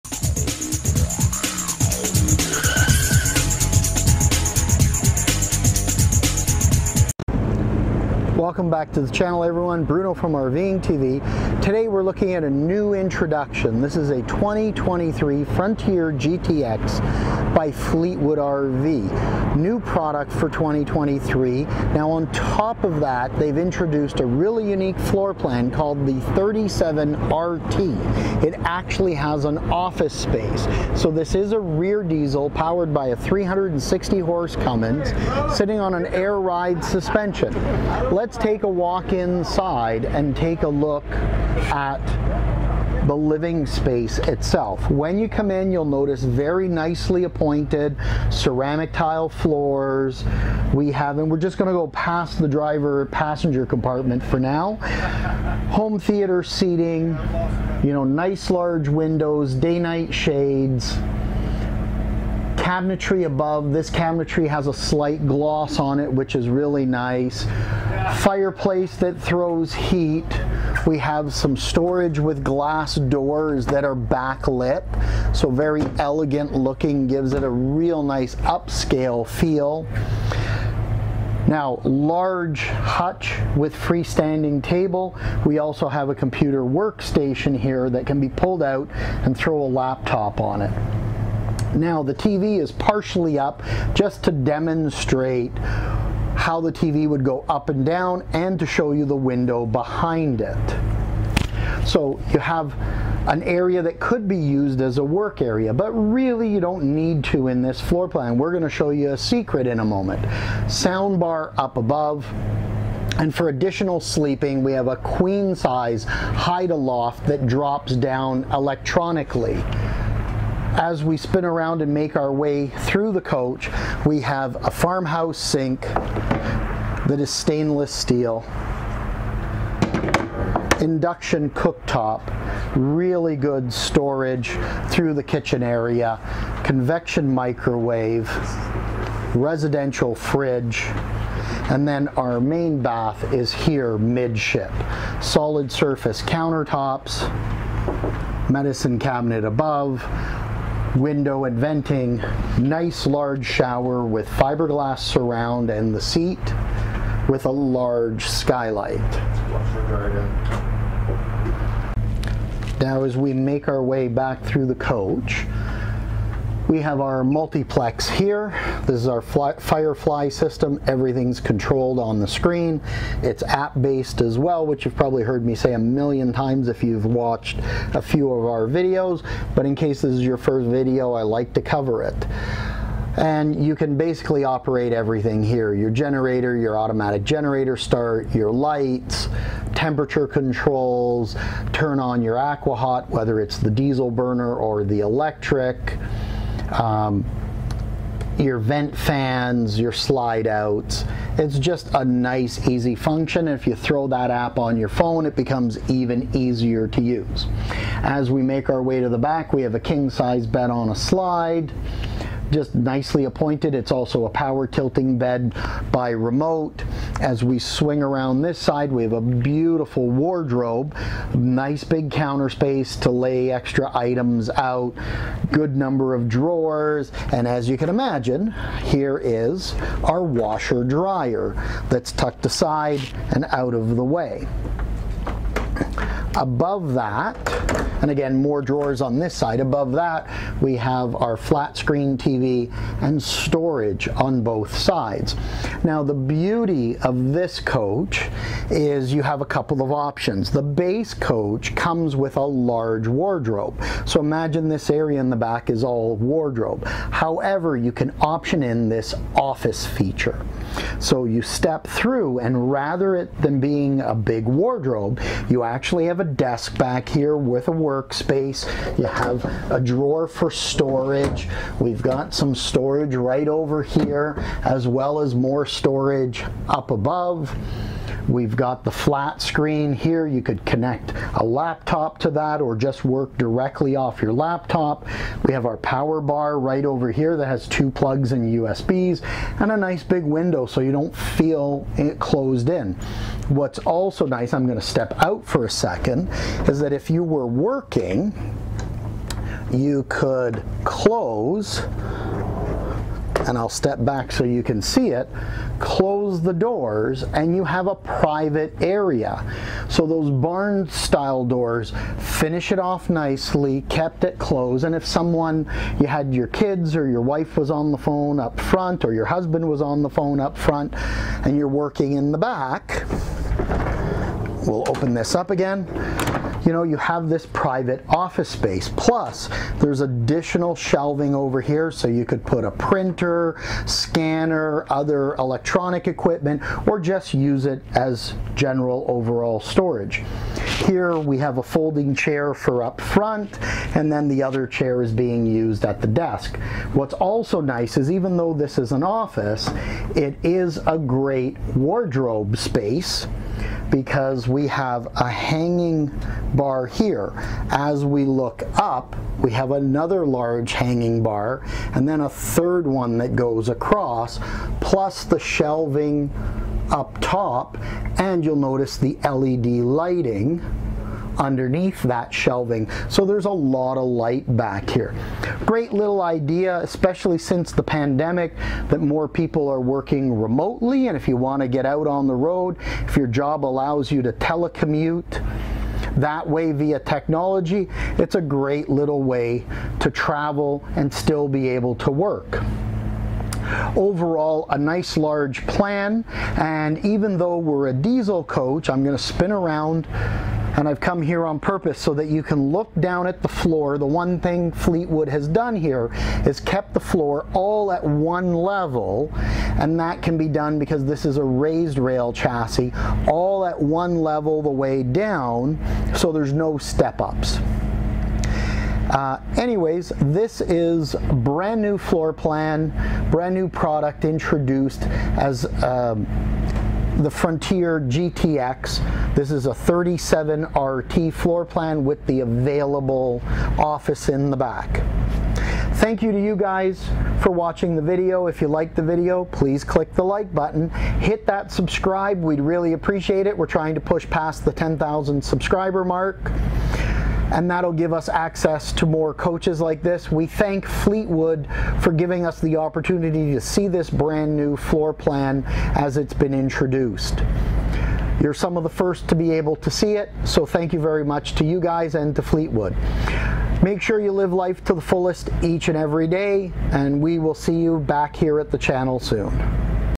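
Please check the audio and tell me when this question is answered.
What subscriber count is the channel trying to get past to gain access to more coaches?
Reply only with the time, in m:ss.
7:24.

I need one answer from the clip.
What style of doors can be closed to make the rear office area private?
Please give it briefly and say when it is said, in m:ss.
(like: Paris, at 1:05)
Barn style, at 5:10.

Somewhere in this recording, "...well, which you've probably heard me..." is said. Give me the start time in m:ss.
2:54.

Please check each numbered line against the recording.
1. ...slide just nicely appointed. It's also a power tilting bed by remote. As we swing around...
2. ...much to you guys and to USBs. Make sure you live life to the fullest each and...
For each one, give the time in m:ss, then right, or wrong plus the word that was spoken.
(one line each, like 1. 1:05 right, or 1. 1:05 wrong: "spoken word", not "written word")
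1. 3:30 right
2. 7:41 wrong: "Fleetwood", not "USBs".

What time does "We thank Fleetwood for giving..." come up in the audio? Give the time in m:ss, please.
7:30.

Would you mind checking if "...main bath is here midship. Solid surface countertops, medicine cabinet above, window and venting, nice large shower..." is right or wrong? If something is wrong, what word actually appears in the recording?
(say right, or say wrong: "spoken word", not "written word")
right.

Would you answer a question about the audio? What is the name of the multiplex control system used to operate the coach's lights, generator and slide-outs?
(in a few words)
Firefly.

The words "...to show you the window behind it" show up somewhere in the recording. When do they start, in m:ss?
1:38.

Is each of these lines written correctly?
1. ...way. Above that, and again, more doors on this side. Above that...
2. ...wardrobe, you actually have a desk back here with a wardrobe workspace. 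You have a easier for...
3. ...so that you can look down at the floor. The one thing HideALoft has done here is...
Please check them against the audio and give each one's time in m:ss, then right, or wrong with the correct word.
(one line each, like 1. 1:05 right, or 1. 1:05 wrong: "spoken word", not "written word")
1. 3:54 wrong: "drawers", not "doors"
2. 4:24 wrong: "drawer", not "easier"
3. 6:41 wrong: "Fleetwood", not "HideALoft".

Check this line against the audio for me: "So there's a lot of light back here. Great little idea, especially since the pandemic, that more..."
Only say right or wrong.
right.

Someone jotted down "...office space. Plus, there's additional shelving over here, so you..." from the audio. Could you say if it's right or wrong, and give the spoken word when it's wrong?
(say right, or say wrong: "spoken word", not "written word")
right.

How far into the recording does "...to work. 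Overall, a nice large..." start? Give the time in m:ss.
6:31.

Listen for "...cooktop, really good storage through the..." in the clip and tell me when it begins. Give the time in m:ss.
2:11.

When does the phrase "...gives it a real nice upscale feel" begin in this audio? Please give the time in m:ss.
1:17.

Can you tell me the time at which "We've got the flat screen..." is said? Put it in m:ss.
4:38.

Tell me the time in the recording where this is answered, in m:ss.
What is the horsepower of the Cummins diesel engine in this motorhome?
0:33.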